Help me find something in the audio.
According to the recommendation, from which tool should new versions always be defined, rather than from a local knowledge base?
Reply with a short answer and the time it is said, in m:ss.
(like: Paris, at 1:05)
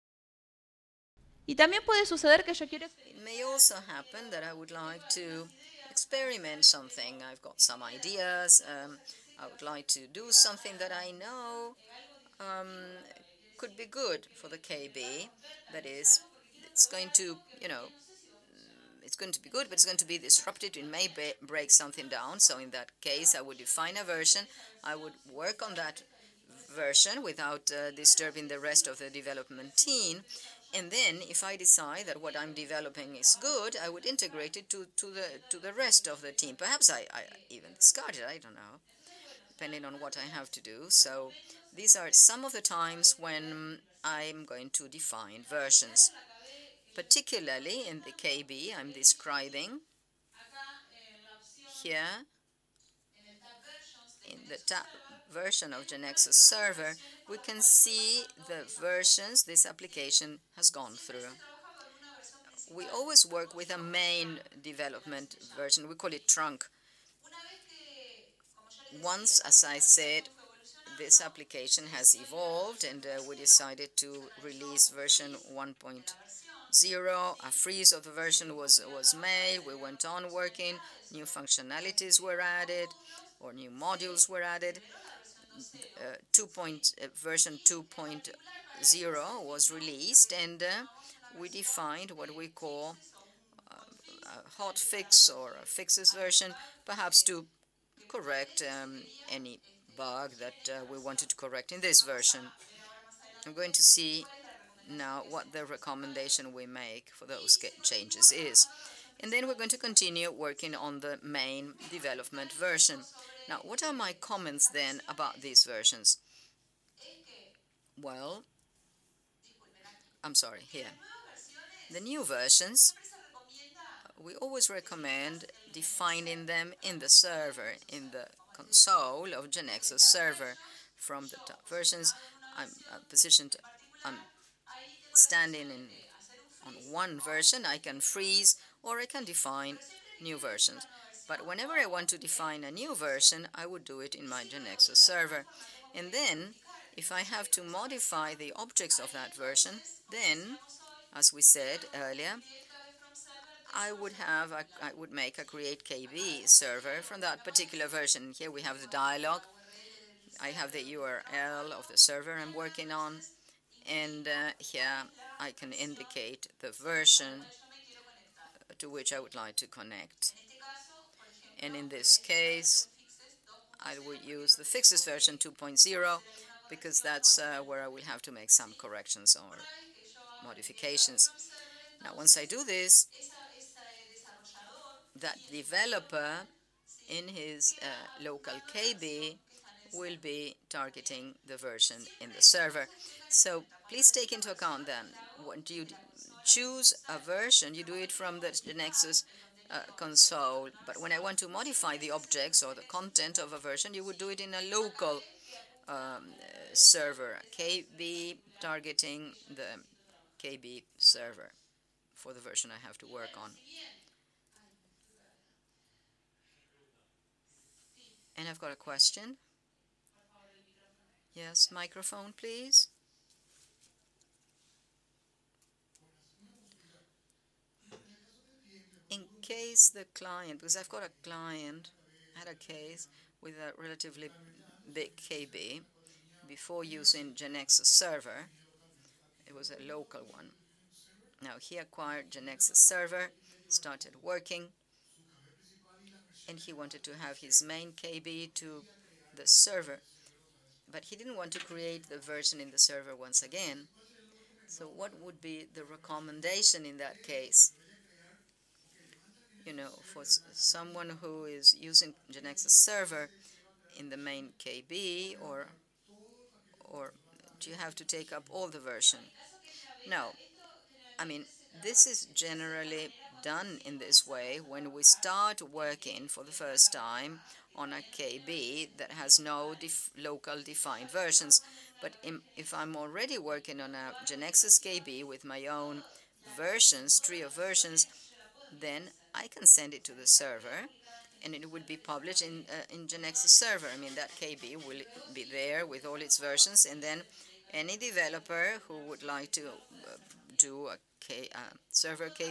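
GeneXus console, at 3:18.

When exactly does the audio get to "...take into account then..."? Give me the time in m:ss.
3:14.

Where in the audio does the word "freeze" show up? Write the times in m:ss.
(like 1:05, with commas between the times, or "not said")
1:17, 2:17.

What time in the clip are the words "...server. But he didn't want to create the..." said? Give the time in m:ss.
4:09.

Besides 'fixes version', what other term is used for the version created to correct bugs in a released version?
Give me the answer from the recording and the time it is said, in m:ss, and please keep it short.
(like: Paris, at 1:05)
hot fix, at 1:34.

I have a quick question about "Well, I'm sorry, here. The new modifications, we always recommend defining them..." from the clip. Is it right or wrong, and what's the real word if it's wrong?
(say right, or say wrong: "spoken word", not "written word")
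wrong: "versions", not "modifications".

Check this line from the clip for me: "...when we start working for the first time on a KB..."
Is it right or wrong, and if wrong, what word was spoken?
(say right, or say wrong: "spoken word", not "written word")
right.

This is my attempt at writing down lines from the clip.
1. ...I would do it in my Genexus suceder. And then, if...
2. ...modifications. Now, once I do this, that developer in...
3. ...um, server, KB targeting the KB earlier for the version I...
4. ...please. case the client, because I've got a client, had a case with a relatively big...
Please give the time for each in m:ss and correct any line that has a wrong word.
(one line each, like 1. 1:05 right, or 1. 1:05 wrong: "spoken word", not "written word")
1. 2:23 wrong: "server", not "suceder"
2. 3:00 right
3. 3:25 wrong: "server", not "earlier"
4. 3:42 right.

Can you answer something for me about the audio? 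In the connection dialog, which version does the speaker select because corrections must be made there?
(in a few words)
fixes version 2.0.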